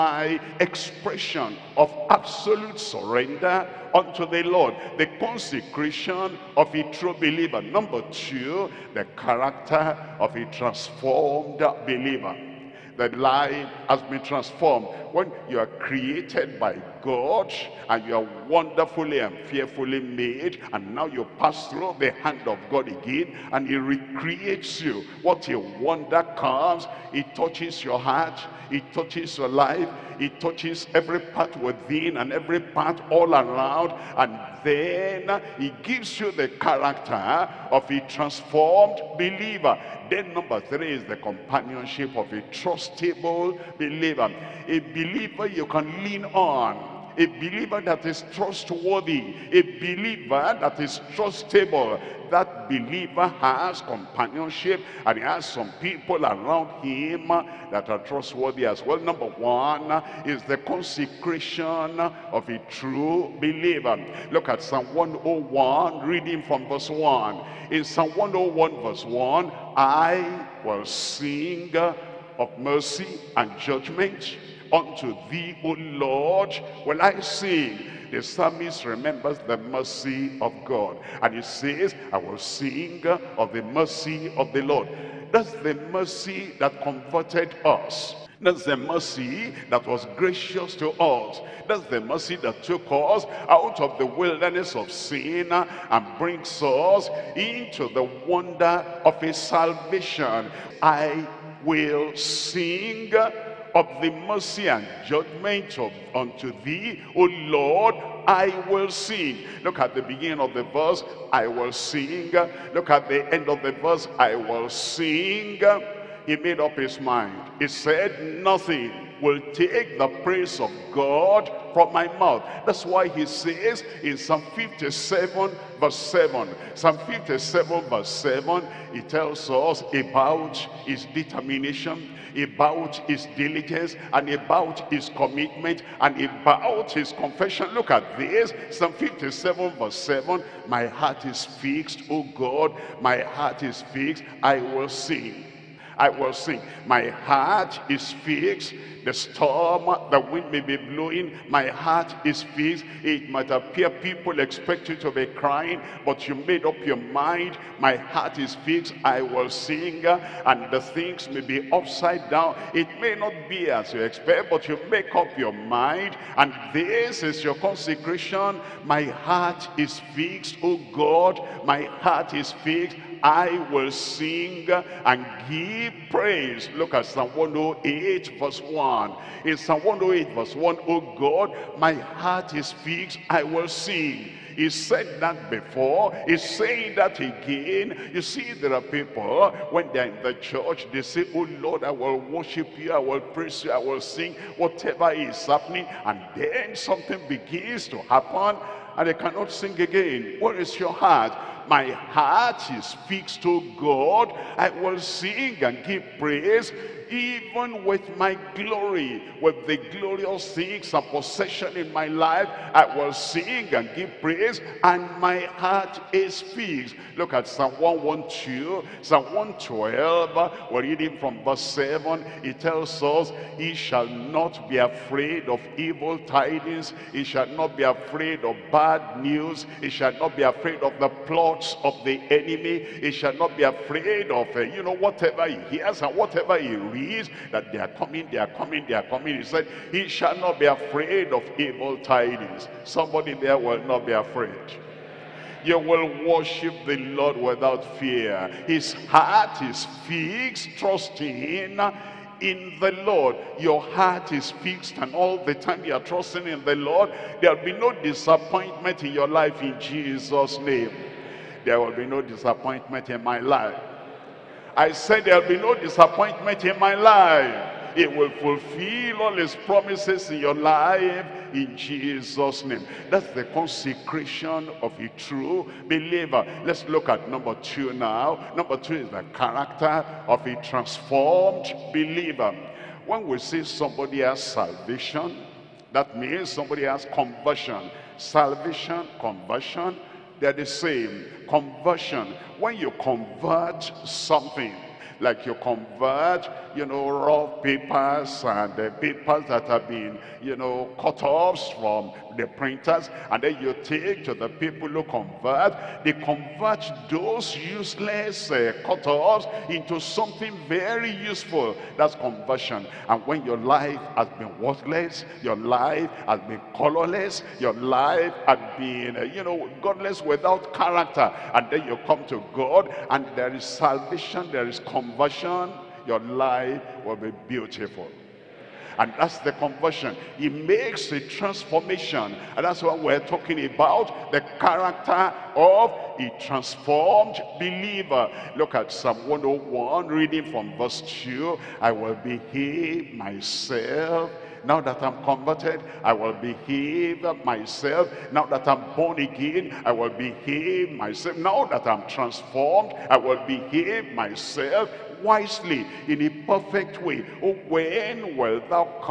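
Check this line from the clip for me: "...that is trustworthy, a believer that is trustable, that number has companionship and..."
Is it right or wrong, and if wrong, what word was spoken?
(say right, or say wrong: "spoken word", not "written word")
wrong: "believer", not "number".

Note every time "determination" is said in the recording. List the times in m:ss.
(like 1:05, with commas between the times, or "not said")
2:11.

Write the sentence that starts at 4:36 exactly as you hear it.
Let's look at number two now.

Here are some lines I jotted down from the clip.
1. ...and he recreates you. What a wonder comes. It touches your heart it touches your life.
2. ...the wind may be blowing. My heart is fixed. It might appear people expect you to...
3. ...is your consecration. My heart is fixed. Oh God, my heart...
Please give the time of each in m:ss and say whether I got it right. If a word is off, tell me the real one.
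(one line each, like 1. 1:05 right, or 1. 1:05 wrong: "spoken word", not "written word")
1. 0:23 right
2. 2:30 right
3. 2:47 right.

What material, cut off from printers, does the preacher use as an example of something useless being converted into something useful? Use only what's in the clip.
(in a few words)
raw papers.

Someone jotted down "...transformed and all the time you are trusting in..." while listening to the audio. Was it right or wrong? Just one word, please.
wrong.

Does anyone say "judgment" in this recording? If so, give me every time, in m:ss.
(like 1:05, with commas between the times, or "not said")
1:13, 1:45.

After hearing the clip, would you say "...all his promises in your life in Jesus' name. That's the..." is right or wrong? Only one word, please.
right.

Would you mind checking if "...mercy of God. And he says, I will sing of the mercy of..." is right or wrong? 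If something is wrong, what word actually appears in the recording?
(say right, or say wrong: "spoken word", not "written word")
right.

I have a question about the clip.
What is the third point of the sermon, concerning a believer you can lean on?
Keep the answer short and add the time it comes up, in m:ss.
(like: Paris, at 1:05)
companionship of a trustable believer, at 0:41.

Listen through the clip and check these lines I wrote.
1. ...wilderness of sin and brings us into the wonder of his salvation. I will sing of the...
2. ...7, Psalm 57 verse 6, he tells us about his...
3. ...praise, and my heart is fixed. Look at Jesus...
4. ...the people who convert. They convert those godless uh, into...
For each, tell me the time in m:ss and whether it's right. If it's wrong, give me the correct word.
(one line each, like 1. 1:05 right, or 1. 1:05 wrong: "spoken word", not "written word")
1. 1:34 right
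2. 2:05 wrong: "7", not "6"
3. 3:34 wrong: "Psalm", not "Jesus"
4. 5:04 wrong: "useless", not "godless".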